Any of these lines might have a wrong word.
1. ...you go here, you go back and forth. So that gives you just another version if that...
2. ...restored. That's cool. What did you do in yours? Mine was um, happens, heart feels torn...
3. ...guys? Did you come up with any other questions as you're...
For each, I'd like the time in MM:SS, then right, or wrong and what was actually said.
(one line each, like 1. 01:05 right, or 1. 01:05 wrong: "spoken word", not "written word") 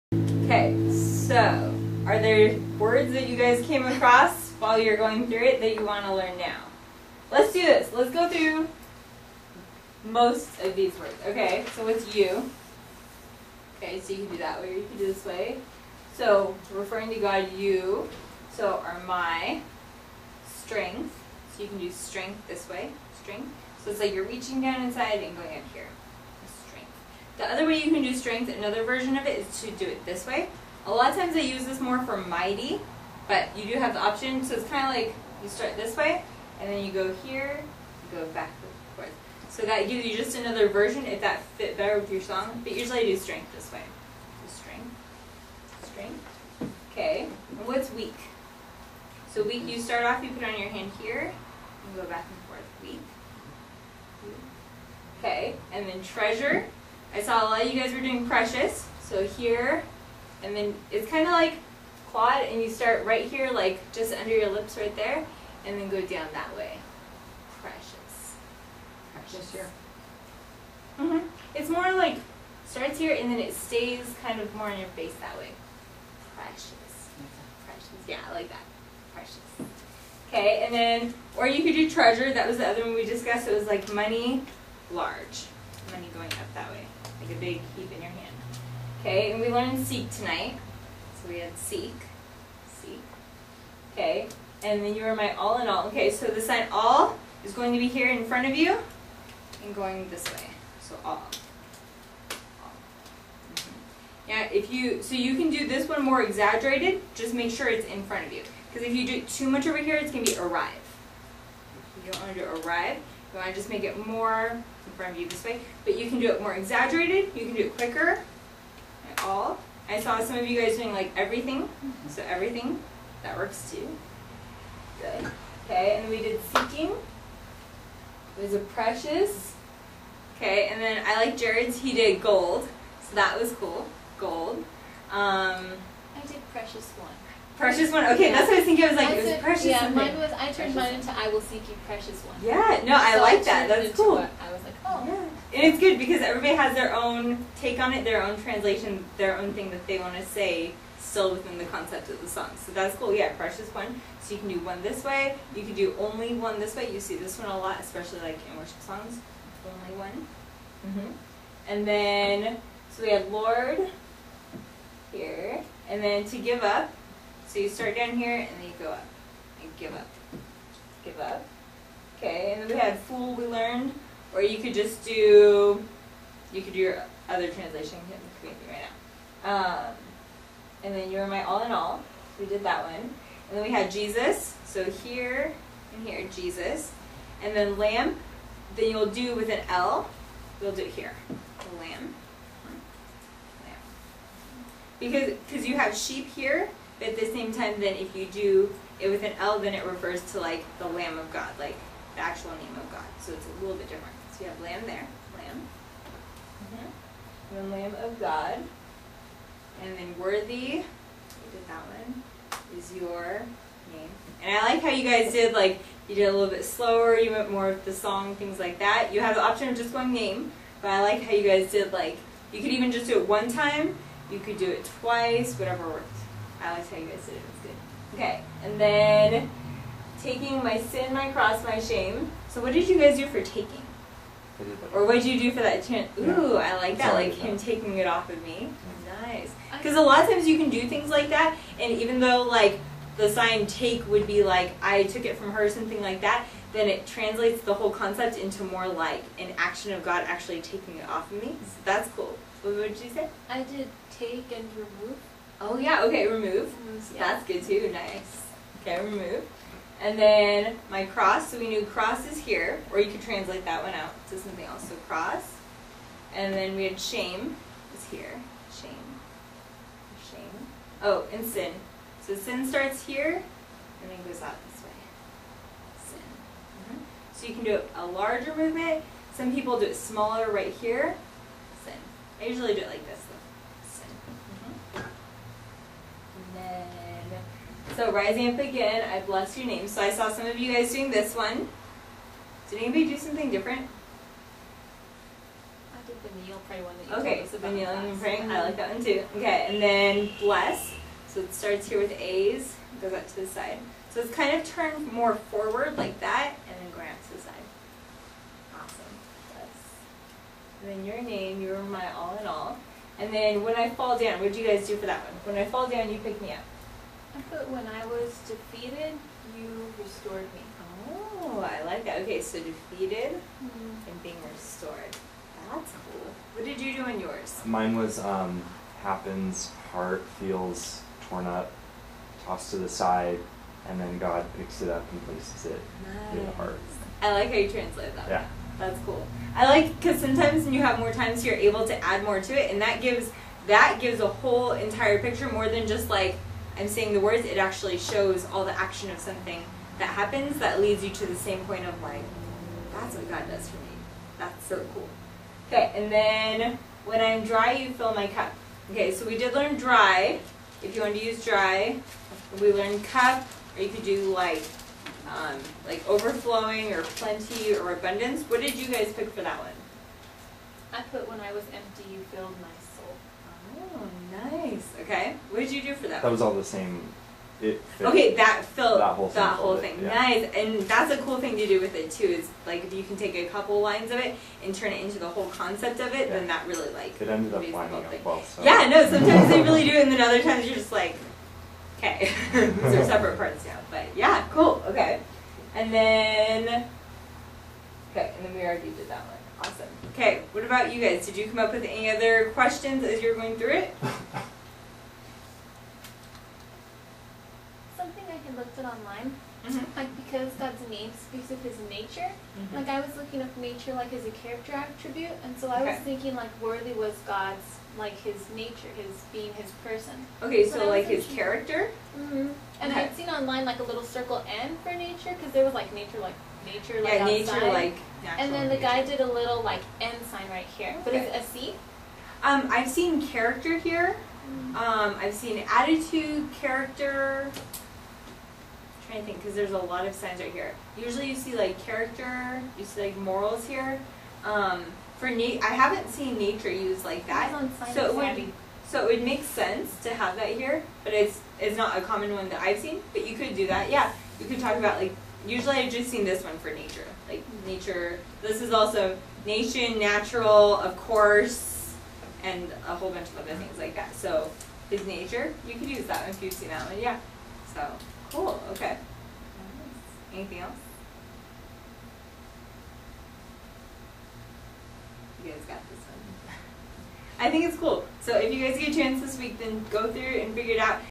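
1. 00:36 right
2. 05:24 right
3. 06:40 right.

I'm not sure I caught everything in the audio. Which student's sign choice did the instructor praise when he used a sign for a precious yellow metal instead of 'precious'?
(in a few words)
Jared.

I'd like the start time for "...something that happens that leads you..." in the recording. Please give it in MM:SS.
05:49.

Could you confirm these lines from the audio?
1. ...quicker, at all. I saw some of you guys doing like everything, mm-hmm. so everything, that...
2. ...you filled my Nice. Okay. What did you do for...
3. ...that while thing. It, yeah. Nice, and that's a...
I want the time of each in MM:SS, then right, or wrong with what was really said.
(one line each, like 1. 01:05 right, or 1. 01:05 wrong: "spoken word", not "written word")
1. 01:57 right
2. 06:12 right
3. 06:19 wrong: "whole", not "while".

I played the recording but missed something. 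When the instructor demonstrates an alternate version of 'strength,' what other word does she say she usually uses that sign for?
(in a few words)
mighty.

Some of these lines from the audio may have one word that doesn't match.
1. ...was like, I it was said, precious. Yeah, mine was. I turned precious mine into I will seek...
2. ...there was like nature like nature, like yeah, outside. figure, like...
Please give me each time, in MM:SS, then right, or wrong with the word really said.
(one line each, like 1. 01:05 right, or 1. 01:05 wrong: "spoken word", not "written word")
1. 02:18 right
2. 07:05 wrong: "nature", not "figure".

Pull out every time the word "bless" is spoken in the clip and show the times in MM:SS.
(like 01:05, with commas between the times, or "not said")
04:49, 05:00, 05:09.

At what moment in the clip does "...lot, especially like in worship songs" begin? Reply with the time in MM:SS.
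02:37.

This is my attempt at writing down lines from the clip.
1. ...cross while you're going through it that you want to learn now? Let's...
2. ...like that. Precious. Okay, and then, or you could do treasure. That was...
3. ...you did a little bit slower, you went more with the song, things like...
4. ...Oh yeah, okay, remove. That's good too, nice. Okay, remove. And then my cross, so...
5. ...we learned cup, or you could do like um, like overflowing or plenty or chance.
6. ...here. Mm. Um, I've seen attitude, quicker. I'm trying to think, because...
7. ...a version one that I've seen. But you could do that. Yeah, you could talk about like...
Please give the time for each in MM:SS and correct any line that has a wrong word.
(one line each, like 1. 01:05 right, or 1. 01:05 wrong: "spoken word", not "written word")
1. 00:03 wrong: "across", not "cross"
2. 01:18 right
3. 03:36 right
4. 04:15 right
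5. 06:02 wrong: "abundance", not "chance"
6. 07:13 wrong: "character", not "quicker"
7. 07:31 wrong: "common", not "version".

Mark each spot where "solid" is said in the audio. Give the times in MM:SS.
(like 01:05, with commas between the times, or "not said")
not said.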